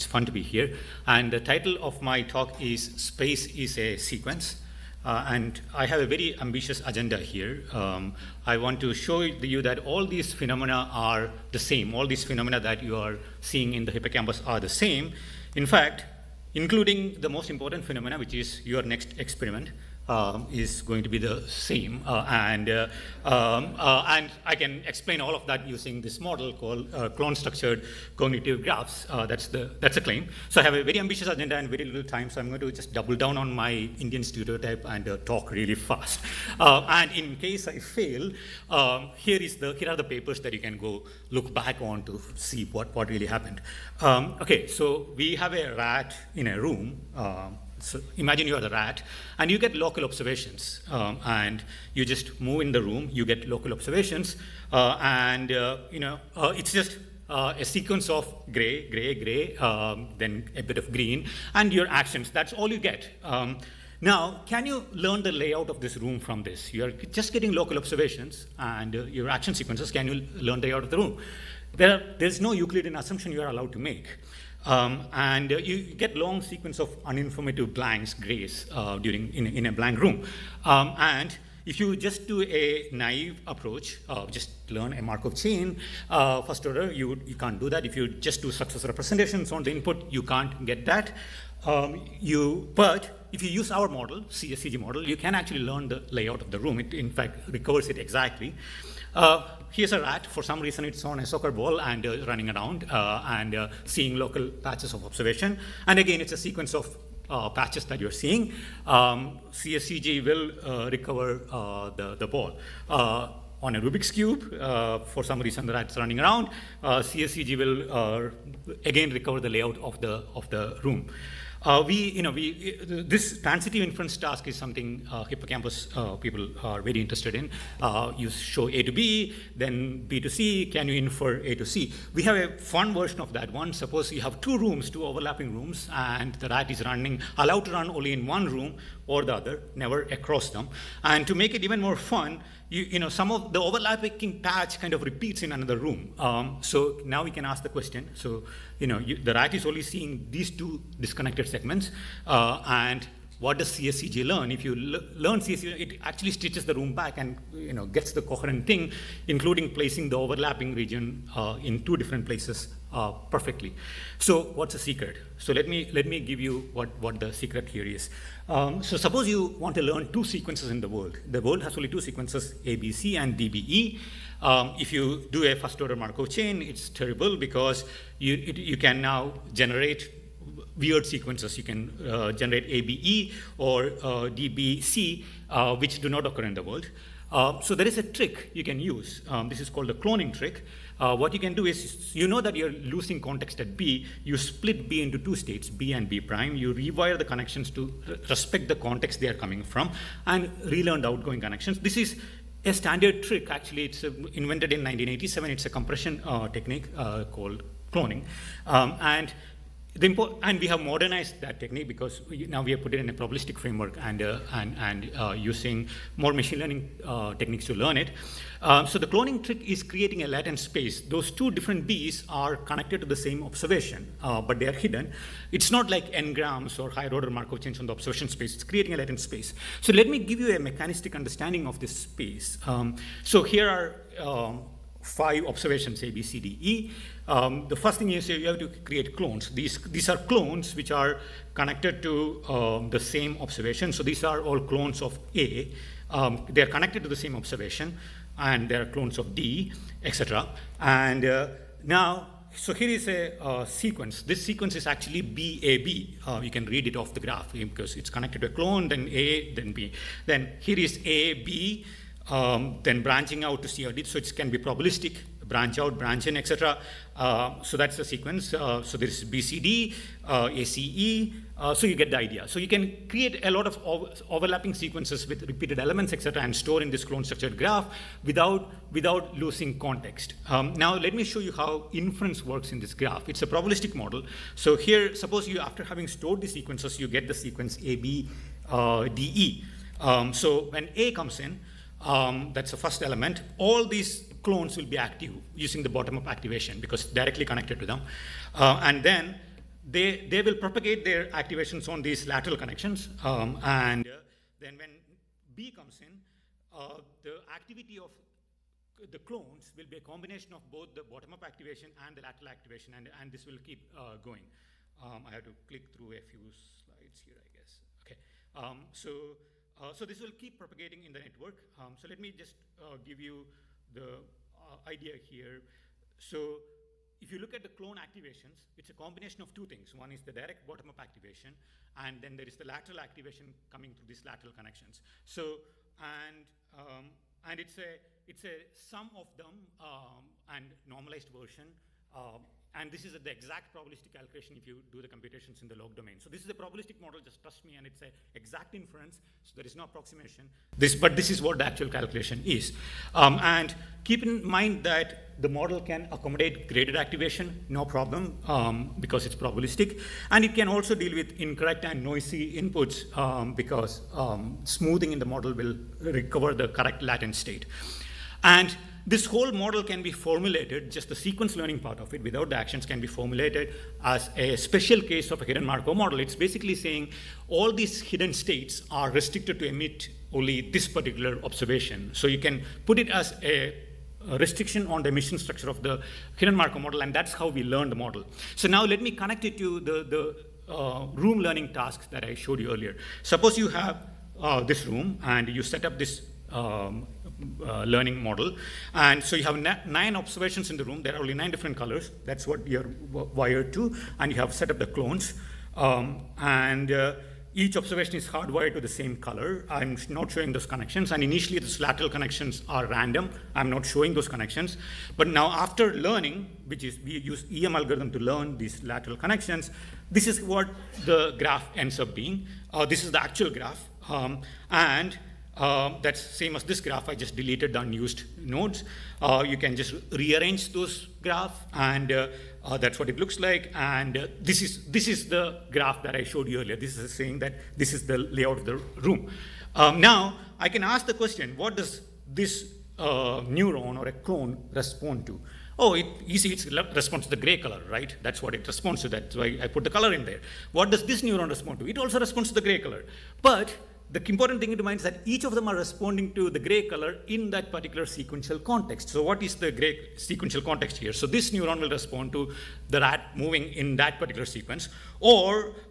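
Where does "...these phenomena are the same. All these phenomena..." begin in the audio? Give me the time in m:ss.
0:10.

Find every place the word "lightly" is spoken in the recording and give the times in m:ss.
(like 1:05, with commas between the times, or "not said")
not said.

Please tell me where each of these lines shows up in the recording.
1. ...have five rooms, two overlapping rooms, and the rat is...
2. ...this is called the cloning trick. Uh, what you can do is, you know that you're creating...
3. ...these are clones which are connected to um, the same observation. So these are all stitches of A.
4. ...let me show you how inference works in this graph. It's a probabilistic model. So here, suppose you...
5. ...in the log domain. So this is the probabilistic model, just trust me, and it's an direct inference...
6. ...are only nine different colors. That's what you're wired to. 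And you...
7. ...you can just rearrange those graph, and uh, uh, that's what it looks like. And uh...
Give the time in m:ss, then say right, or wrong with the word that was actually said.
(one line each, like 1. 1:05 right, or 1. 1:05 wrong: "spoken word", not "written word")
1. 2:14 wrong: "two", not "five"
2. 3:09 wrong: "losing", not "creating"
3. 3:59 wrong: "clones", not "stitches"
4. 4:40 right
5. 5:45 wrong: "exact", not "direct"
6. 6:41 right
7. 7:09 right.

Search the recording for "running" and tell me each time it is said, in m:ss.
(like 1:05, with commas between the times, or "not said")
1:42, 1:55, 2:16.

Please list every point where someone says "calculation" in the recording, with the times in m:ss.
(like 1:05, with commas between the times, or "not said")
5:44, 5:51.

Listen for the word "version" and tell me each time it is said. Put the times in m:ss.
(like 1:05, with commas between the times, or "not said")
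2:12, 5:41.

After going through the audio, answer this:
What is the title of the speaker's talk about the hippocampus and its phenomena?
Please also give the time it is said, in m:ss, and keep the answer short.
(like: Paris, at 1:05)
Space is a Sequence, at 0:02.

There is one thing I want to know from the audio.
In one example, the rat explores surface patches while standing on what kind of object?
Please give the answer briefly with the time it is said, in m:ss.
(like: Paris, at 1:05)
A soccer ball, at 1:41.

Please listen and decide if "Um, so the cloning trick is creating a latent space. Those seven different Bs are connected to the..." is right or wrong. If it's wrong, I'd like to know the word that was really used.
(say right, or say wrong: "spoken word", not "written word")
wrong: "two", not "seven".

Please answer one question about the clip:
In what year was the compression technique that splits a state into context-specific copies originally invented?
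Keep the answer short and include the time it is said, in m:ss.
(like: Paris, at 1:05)
1987, at 3:24.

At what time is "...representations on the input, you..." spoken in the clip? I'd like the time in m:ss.
1:28.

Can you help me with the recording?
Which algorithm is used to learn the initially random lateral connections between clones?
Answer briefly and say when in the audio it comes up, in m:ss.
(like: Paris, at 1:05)
EM algorithm, at 6:57.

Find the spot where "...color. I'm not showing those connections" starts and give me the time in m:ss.
6:49.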